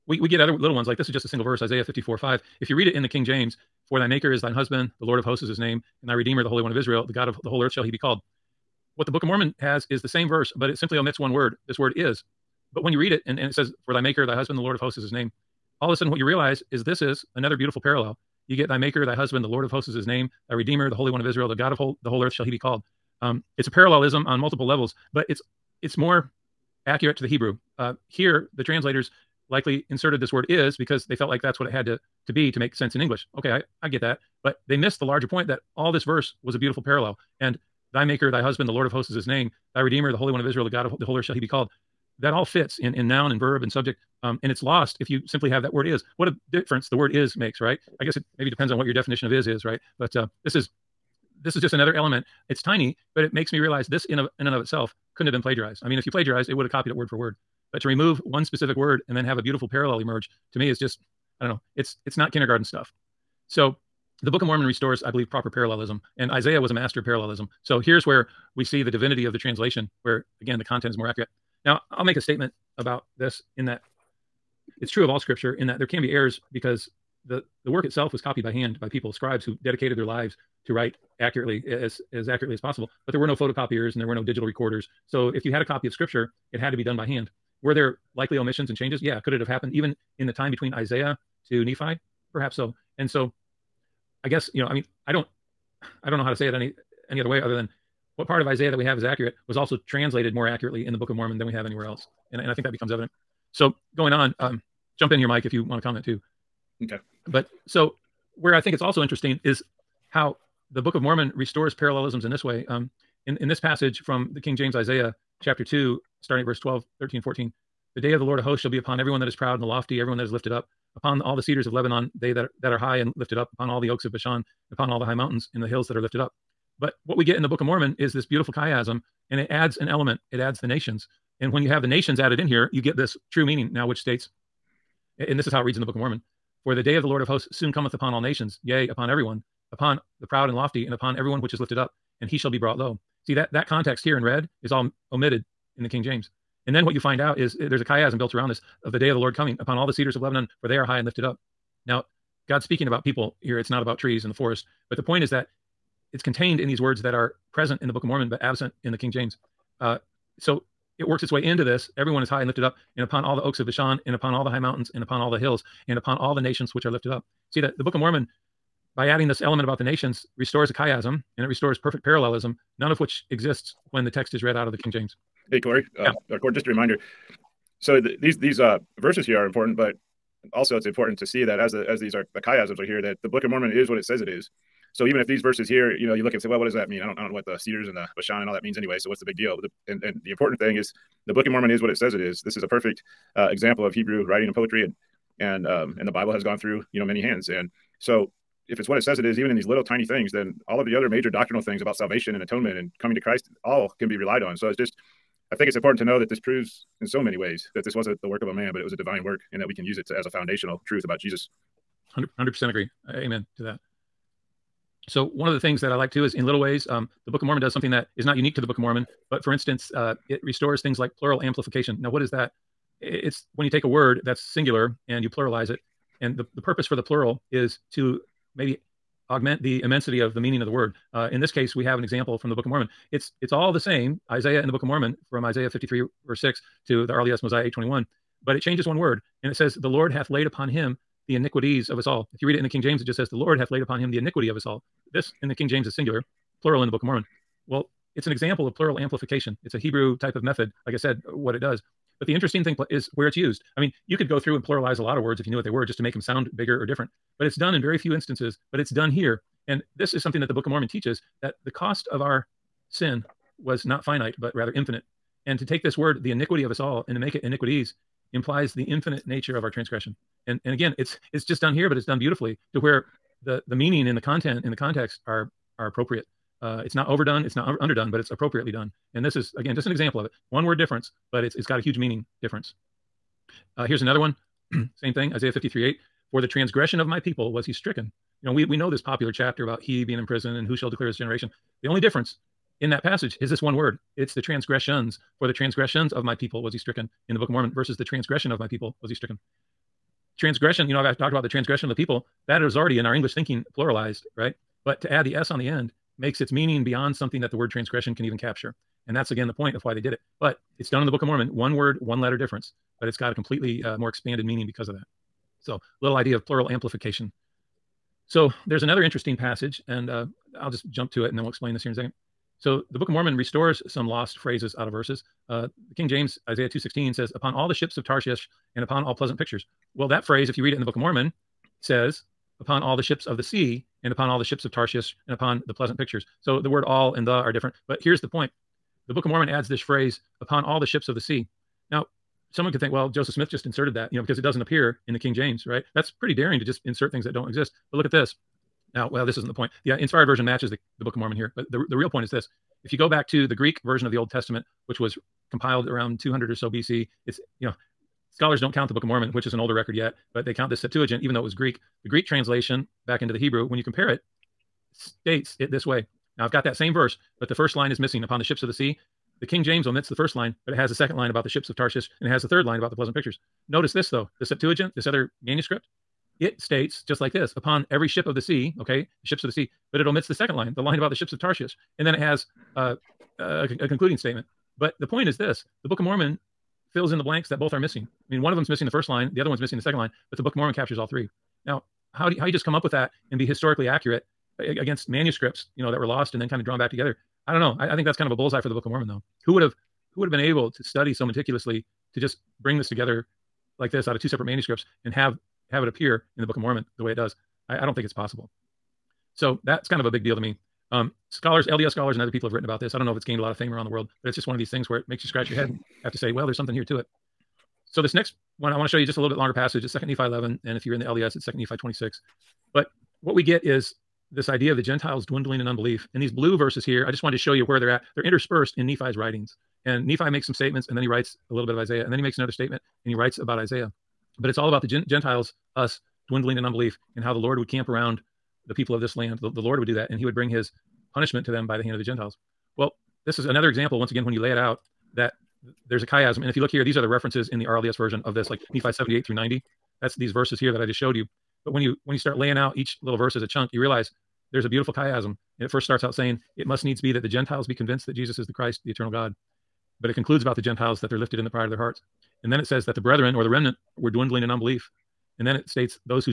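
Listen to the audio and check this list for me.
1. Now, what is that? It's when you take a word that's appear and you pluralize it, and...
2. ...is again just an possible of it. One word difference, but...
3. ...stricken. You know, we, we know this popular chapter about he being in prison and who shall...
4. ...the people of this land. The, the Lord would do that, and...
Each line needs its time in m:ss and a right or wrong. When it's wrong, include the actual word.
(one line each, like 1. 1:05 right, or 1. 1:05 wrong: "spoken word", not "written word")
1. 3:41 wrong: "singular", not "appear"
2. 4:39 wrong: "example", not "possible"
3. 4:47 right
4. 7:18 right.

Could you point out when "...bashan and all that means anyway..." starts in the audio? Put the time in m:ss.
3:08.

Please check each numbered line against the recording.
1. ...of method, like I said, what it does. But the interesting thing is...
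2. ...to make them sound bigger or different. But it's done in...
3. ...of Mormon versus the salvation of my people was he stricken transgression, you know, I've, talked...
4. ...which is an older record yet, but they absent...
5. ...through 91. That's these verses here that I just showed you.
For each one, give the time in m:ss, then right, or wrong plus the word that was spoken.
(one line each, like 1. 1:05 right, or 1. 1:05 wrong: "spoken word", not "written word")
1. 4:10 right
2. 4:15 right
3. 4:57 wrong: "transgression", not "salvation"
4. 5:59 wrong: "count", not "absent"
5. 7:29 wrong: "90", not "91".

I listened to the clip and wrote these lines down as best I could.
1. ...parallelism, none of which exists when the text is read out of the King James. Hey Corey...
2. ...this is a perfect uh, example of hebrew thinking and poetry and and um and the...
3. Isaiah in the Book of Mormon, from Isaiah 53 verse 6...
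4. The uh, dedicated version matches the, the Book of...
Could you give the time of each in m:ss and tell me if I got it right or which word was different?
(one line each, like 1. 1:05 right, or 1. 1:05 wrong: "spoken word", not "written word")
1. 2:52 right
2. 3:12 wrong: "writing", not "thinking"
3. 3:54 right
4. 5:49 wrong: "inspired", not "dedicated".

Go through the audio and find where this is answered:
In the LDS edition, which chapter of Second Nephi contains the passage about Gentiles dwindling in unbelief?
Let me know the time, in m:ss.
7:01.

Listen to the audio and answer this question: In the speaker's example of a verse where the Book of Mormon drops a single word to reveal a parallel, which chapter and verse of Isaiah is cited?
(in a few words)
Isaiah 54:5.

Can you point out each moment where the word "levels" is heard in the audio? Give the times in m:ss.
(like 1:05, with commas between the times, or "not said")
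0:24.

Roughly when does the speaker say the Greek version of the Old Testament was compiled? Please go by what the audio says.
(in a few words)
around 200 BC.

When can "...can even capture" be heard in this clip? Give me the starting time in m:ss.
5:08.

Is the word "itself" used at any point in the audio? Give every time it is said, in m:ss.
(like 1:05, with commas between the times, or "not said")
0:54, 1:17.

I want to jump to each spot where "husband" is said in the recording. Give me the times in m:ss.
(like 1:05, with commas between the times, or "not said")
0:04, 0:14, 0:19, 0:38.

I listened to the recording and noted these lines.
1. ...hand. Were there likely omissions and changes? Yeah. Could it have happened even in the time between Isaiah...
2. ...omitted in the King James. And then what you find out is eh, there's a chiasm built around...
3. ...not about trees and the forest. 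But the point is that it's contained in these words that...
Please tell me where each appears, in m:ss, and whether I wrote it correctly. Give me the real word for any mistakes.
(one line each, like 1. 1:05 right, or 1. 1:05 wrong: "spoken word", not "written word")
1. 1:27 right
2. 2:25 right
3. 2:33 right.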